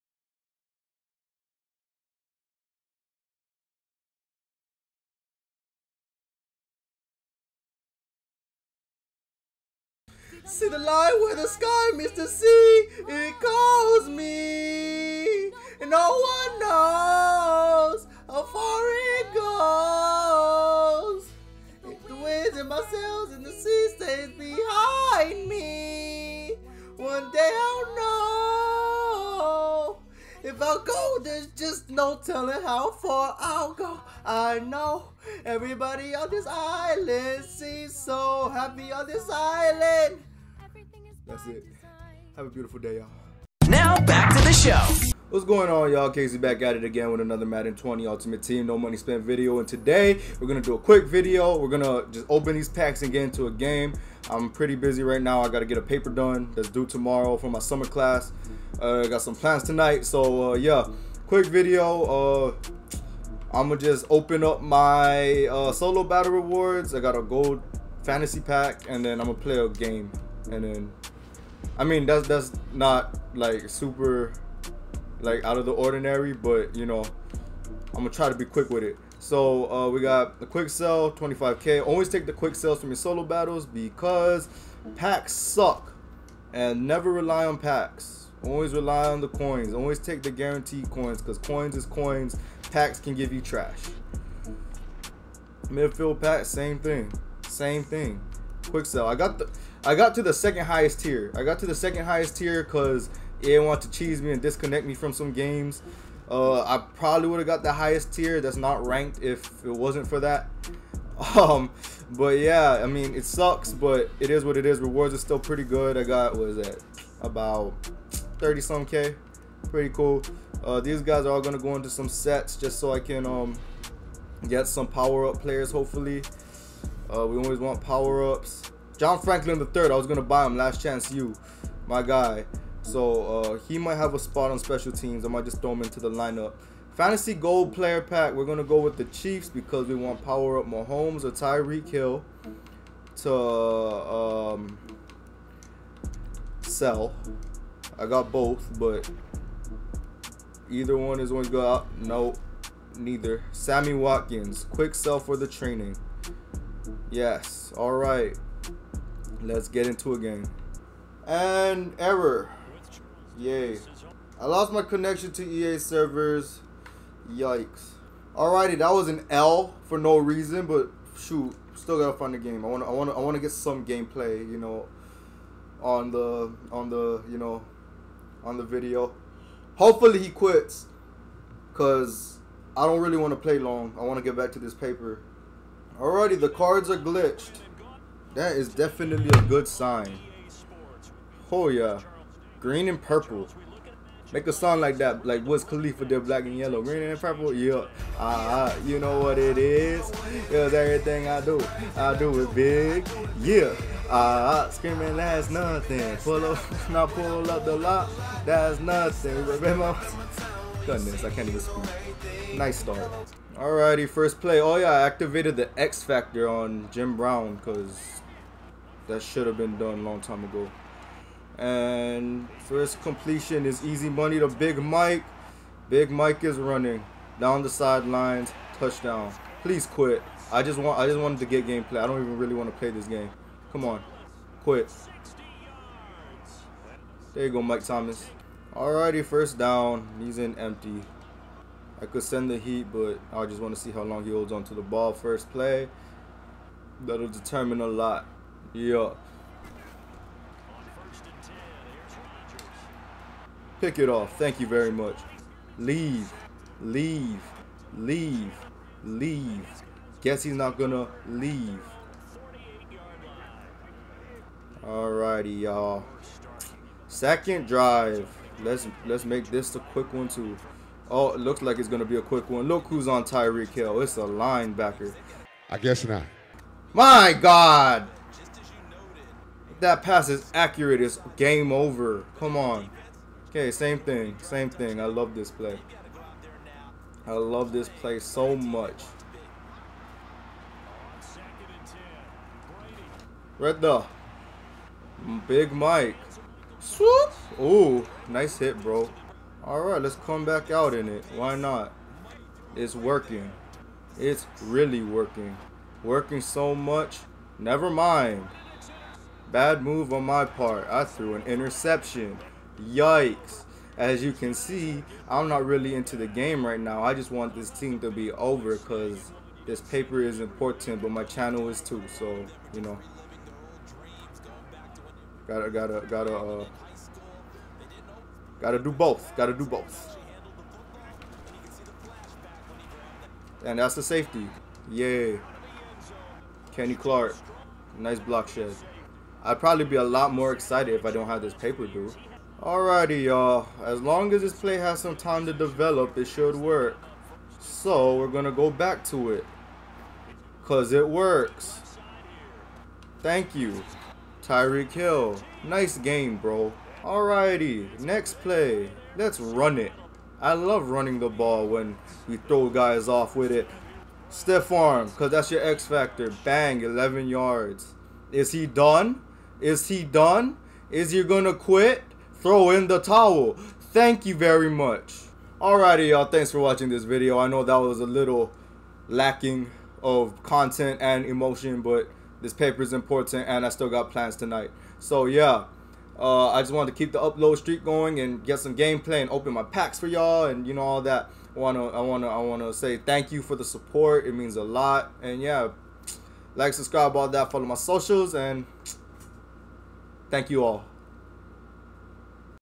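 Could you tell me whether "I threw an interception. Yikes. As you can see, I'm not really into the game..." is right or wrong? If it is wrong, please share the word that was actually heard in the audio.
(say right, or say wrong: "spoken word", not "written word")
right.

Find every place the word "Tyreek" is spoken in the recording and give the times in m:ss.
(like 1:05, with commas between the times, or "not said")
2:21, 4:33, 5:54.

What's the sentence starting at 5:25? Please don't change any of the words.
Gotta, gotta, gotta, uh, gotta do both.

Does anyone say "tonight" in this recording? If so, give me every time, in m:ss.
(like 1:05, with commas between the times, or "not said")
0:59, 6:24.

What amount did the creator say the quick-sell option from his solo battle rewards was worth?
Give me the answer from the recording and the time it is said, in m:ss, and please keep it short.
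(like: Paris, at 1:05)
25k, at 1:21.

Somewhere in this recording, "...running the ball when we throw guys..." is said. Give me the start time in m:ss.
6:00.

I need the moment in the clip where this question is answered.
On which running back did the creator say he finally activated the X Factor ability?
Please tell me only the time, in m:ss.
3:36.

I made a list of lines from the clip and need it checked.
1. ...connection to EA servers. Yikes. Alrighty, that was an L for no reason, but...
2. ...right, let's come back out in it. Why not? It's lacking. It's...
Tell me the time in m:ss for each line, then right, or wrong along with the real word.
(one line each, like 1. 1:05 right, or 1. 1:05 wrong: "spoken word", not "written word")
1. 2:44 right
2. 4:59 wrong: "working", not "lacking".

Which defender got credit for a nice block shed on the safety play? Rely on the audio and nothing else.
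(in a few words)
Kenny Clark.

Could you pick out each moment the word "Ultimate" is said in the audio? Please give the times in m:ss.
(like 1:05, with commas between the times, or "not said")
0:48.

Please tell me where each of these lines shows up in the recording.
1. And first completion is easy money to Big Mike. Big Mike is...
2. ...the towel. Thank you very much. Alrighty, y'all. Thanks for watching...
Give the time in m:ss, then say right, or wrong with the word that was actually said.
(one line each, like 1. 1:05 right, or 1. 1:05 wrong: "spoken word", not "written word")
1. 3:41 right
2. 6:12 right.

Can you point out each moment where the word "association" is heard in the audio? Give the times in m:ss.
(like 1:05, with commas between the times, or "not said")
not said.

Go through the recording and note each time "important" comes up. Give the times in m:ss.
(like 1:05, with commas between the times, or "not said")
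5:20, 6:22.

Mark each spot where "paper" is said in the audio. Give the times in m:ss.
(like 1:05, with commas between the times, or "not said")
0:55, 3:04, 5:19, 5:41, 6:22.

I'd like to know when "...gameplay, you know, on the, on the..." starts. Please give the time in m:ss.
2:53.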